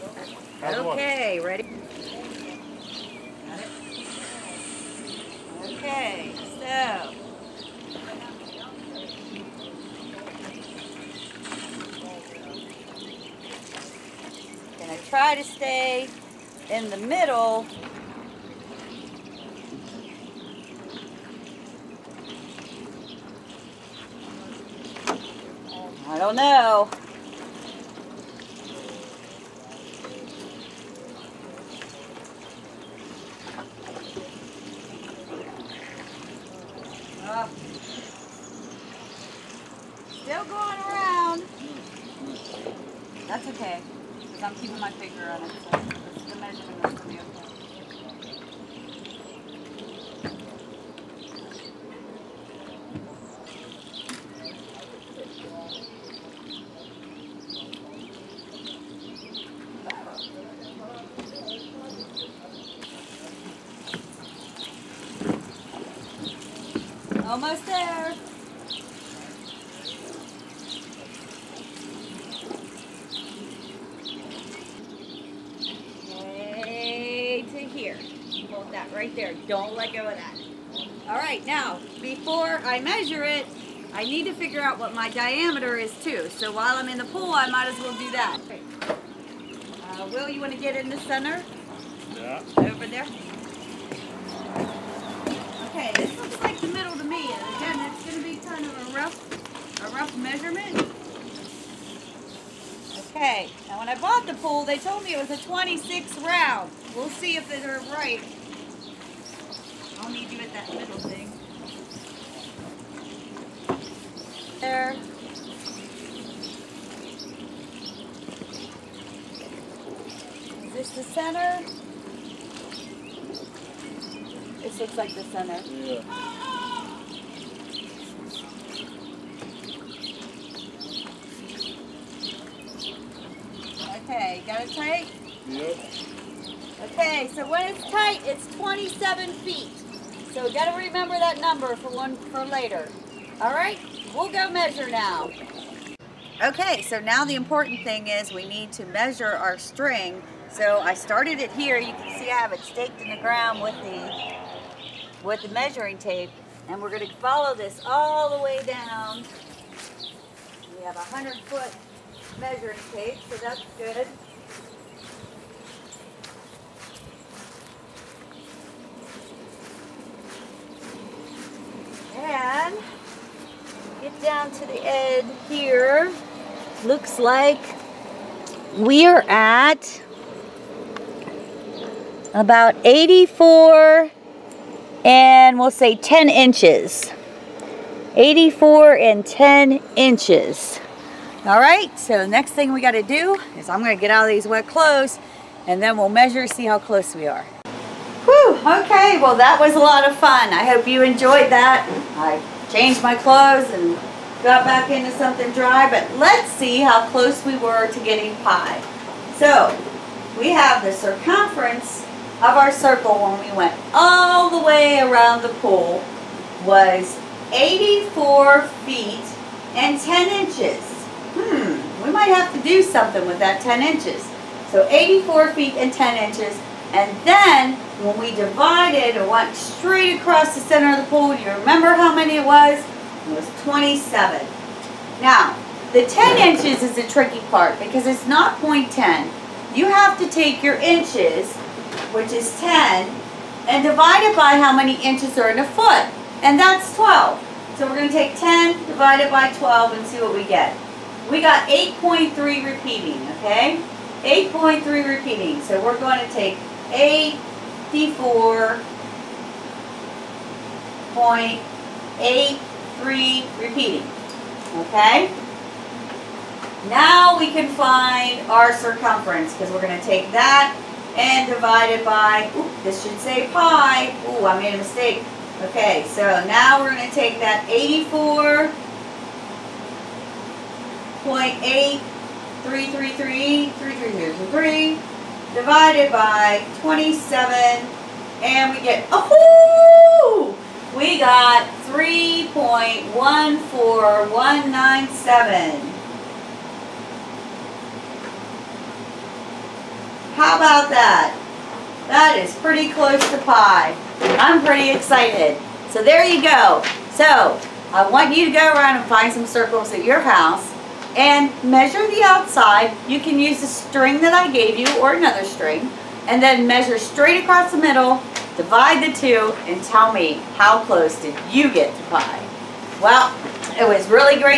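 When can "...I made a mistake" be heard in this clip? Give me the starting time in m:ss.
4:34.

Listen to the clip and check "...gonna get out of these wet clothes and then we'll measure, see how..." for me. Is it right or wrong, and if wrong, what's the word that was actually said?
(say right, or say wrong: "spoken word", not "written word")
right.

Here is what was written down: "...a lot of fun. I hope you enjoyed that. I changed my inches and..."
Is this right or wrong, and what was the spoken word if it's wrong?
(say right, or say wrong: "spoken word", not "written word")
wrong: "clothes", not "inches".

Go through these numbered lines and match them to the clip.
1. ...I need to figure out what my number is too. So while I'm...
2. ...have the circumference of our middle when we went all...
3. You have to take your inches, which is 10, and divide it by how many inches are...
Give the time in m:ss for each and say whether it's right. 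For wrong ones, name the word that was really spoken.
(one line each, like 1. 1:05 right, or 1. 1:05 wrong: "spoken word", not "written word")
1. 1:23 wrong: "diameter", not "number"
2. 3:30 wrong: "circle", not "middle"
3. 3:59 right.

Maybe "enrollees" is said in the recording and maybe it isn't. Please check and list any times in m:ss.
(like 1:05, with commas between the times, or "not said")
not said.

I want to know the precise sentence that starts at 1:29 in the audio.
Uh, Will, you want to get in the center?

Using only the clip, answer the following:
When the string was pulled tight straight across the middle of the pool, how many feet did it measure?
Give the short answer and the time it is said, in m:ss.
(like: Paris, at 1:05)
27 feet, at 2:18.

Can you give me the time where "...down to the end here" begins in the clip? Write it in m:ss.
2:54.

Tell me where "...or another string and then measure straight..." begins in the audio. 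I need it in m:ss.
5:15.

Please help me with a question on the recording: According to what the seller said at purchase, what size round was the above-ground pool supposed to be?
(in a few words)
26.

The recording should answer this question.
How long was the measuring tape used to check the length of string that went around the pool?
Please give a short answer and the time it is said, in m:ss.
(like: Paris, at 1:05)
100 feet, at 2:41.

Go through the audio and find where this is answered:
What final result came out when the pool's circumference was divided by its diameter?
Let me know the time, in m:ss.
4:51.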